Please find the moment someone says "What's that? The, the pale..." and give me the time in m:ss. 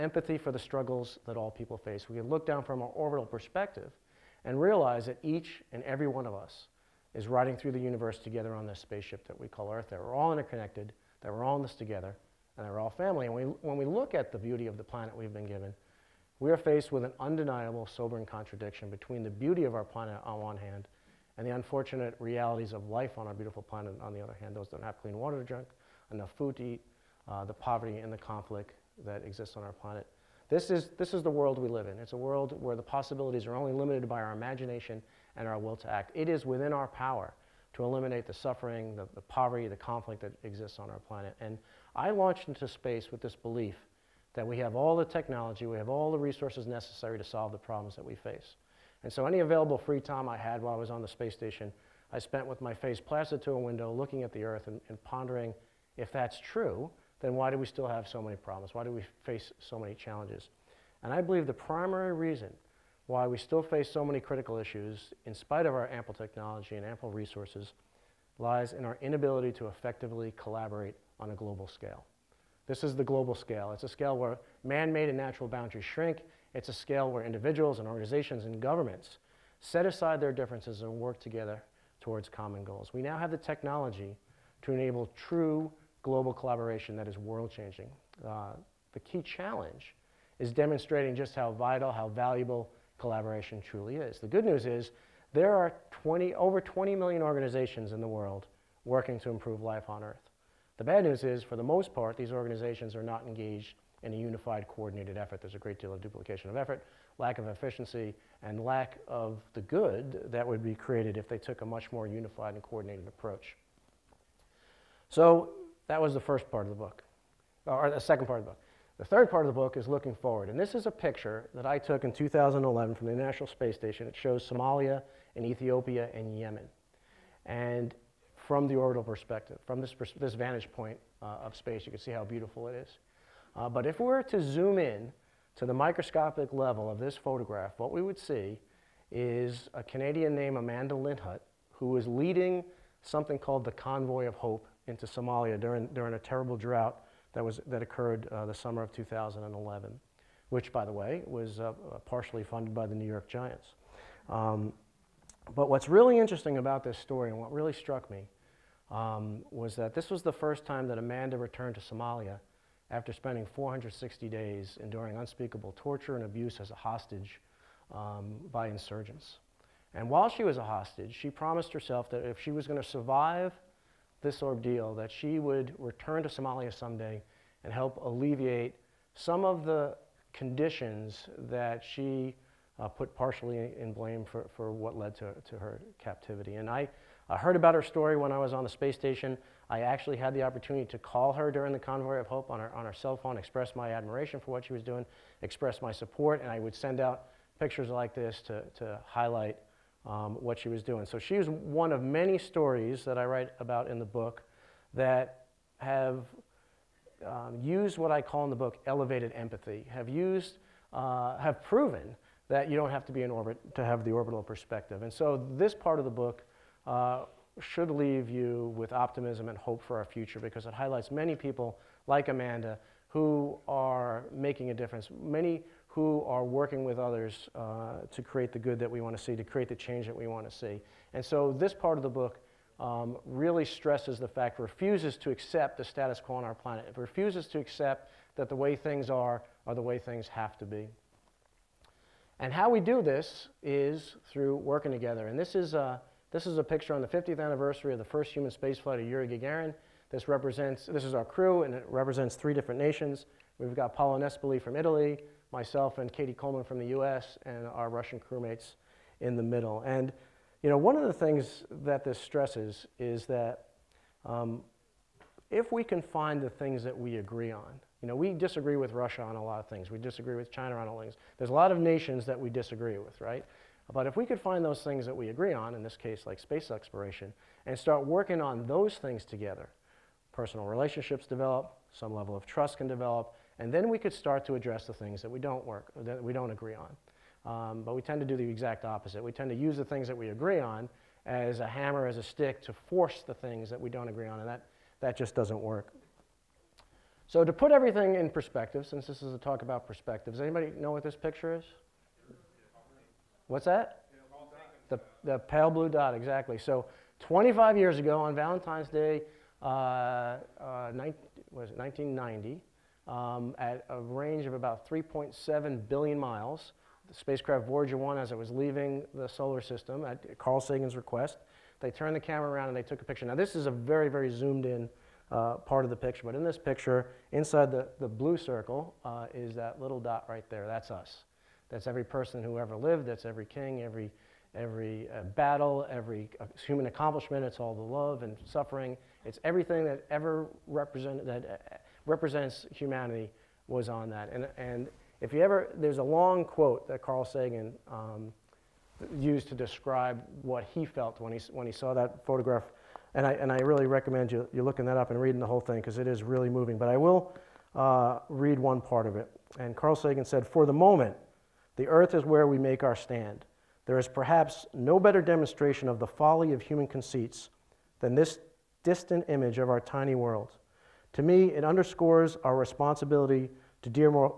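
5:03.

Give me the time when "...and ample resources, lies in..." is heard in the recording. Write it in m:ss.
1:06.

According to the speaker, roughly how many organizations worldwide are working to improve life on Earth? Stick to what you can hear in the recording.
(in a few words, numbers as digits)
over 20 million.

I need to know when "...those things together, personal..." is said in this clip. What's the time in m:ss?
4:38.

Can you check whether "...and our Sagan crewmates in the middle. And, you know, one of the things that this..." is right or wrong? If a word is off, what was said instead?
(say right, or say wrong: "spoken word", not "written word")
wrong: "Russian", not "Sagan".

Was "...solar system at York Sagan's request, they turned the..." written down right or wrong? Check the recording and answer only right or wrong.
wrong.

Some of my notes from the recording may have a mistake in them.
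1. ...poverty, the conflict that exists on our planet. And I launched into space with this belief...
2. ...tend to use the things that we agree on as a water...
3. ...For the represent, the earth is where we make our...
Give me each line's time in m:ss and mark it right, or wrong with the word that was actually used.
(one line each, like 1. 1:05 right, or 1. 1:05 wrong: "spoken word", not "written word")
1. 0:39 right
2. 4:49 wrong: "hammer", not "water"
3. 6:00 wrong: "moment", not "represent".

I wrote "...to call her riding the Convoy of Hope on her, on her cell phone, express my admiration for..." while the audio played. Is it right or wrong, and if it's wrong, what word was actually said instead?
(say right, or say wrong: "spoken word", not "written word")
wrong: "during", not "riding".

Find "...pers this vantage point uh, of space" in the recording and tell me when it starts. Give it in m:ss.
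2:09.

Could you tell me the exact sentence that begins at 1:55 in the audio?
So that was the first part of the book, or the second part of the book.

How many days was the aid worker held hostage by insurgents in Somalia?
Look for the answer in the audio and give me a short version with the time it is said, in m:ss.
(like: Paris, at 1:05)
460, at 2:43.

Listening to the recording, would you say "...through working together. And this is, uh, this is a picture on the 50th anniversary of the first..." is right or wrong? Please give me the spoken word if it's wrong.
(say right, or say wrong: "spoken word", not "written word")
right.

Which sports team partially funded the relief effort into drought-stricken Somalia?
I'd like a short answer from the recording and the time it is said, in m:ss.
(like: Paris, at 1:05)
New York Giants, at 2:32.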